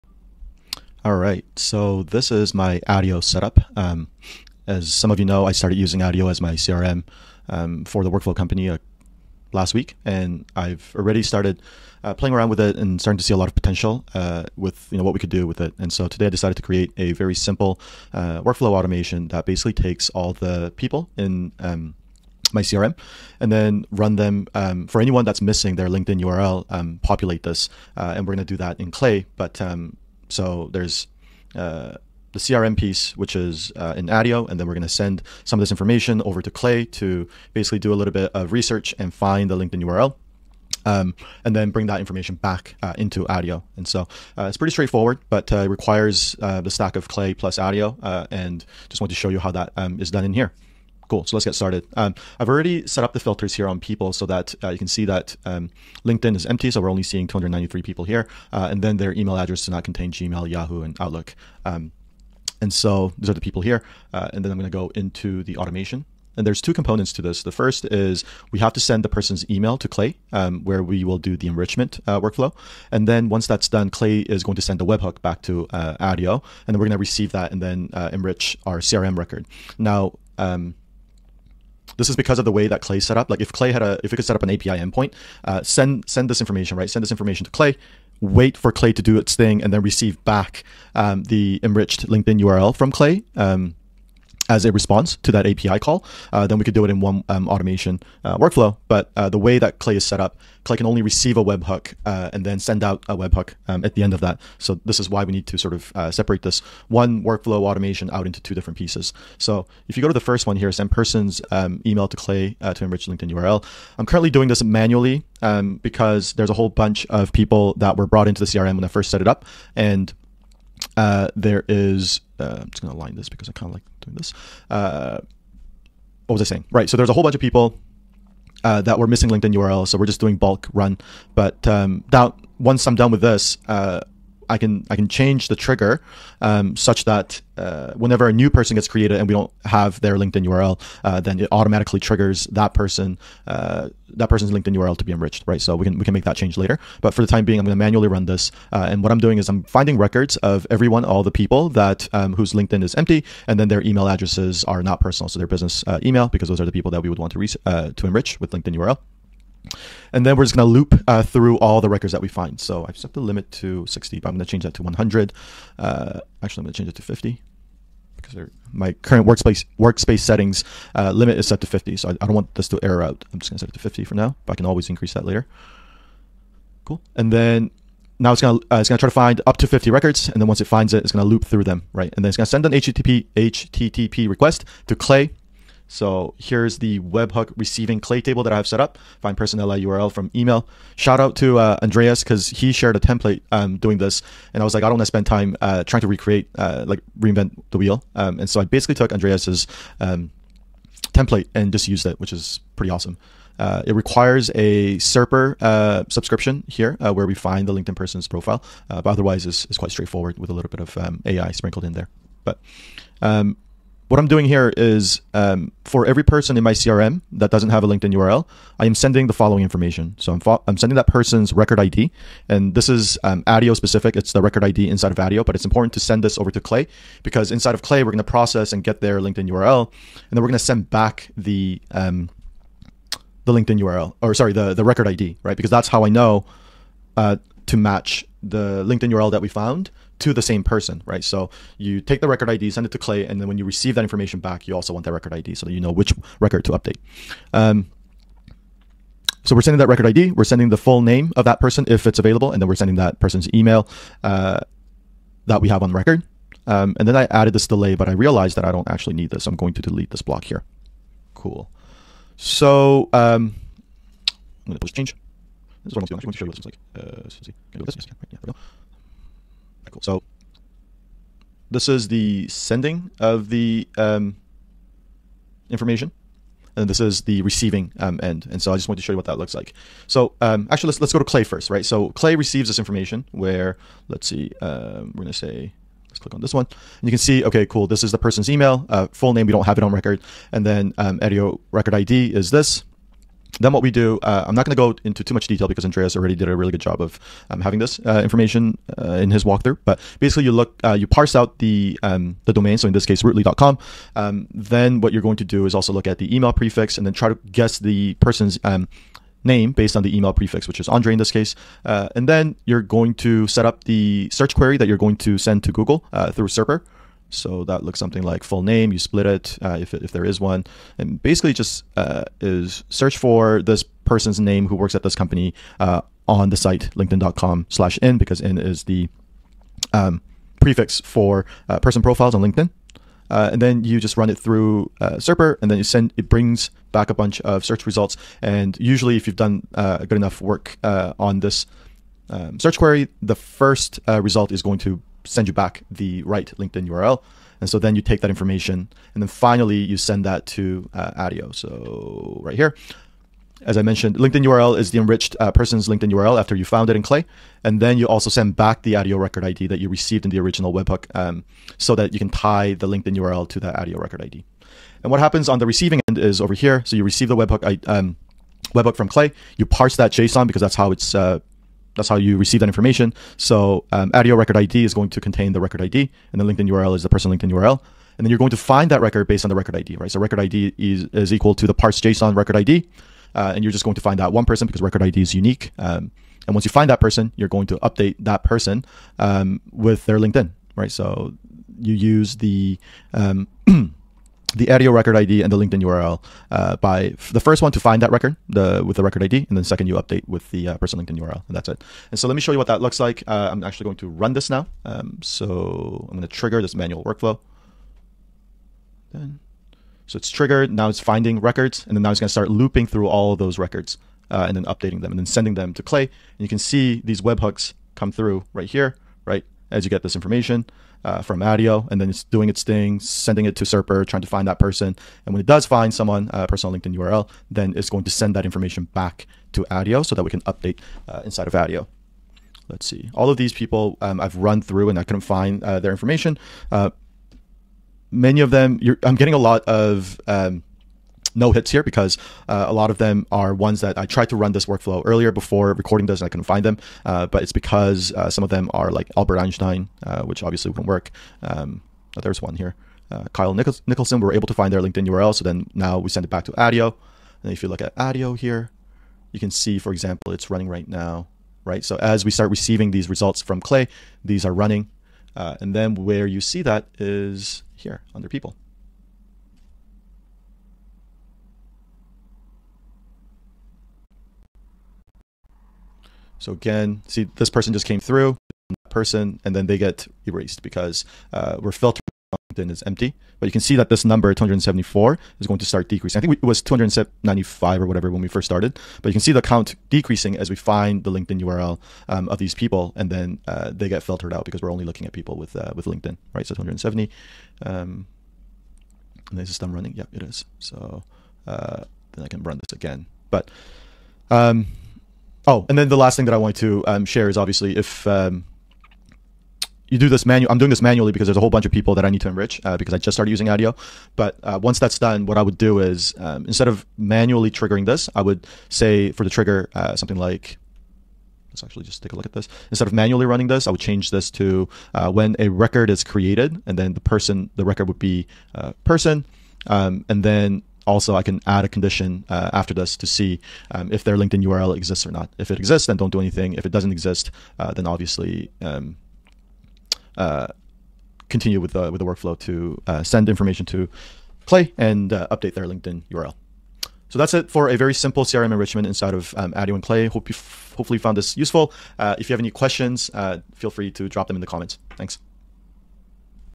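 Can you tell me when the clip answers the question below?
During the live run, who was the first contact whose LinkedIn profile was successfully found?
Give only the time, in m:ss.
7:33.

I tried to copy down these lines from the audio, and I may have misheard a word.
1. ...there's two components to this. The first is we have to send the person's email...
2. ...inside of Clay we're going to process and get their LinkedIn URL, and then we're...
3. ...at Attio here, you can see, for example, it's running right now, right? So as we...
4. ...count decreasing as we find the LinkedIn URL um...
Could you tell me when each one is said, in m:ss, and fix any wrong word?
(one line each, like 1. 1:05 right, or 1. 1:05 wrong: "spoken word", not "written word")
1. 1:06 right
2. 3:47 right
3. 7:37 right
4. 8:09 right.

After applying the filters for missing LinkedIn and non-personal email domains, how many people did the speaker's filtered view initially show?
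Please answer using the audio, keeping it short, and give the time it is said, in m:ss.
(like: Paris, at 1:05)
293, at 0:57.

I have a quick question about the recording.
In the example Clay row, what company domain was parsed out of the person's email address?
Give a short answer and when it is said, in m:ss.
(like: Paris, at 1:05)
rootly.com, at 5:03.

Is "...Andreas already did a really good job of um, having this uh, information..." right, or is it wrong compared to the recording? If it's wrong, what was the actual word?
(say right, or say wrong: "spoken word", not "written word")
right.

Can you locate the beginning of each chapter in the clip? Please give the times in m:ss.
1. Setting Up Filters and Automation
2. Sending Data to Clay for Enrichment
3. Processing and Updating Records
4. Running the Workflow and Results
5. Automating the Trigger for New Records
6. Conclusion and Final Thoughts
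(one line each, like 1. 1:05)
1. 0:51
2. 1:49
3. 3:02
4. 6:44
5. 8:30
6. 9:07.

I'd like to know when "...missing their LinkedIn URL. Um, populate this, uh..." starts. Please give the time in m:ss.
0:25.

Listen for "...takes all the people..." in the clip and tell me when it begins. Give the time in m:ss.
0:19.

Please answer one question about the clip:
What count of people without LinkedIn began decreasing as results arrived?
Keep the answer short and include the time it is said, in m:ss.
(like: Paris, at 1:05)
274, at 8:04.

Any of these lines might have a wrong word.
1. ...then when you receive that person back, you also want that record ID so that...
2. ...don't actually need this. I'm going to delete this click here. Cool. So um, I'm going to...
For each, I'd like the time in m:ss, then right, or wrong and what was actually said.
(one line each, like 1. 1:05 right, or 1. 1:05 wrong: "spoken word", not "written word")
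1. 4:03 wrong: "information", not "person"
2. 4:18 wrong: "block", not "click".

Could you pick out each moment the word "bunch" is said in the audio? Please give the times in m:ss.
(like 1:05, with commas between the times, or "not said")
1:56, 2:07, 5:37, 8:31.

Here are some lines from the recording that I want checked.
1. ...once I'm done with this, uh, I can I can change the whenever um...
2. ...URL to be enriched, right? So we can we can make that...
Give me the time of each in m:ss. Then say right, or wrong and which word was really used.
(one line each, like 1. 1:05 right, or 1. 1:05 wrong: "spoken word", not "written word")
1. 2:12 wrong: "trigger", not "whenever"
2. 2:24 right.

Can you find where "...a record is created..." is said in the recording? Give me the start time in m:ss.
8:45.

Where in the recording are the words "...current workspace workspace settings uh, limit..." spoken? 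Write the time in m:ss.
2:48.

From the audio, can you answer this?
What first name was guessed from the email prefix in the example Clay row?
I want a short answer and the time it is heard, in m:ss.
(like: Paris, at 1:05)
Andre, at 5:10.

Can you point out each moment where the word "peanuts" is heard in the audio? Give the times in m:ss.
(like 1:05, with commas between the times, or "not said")
not said.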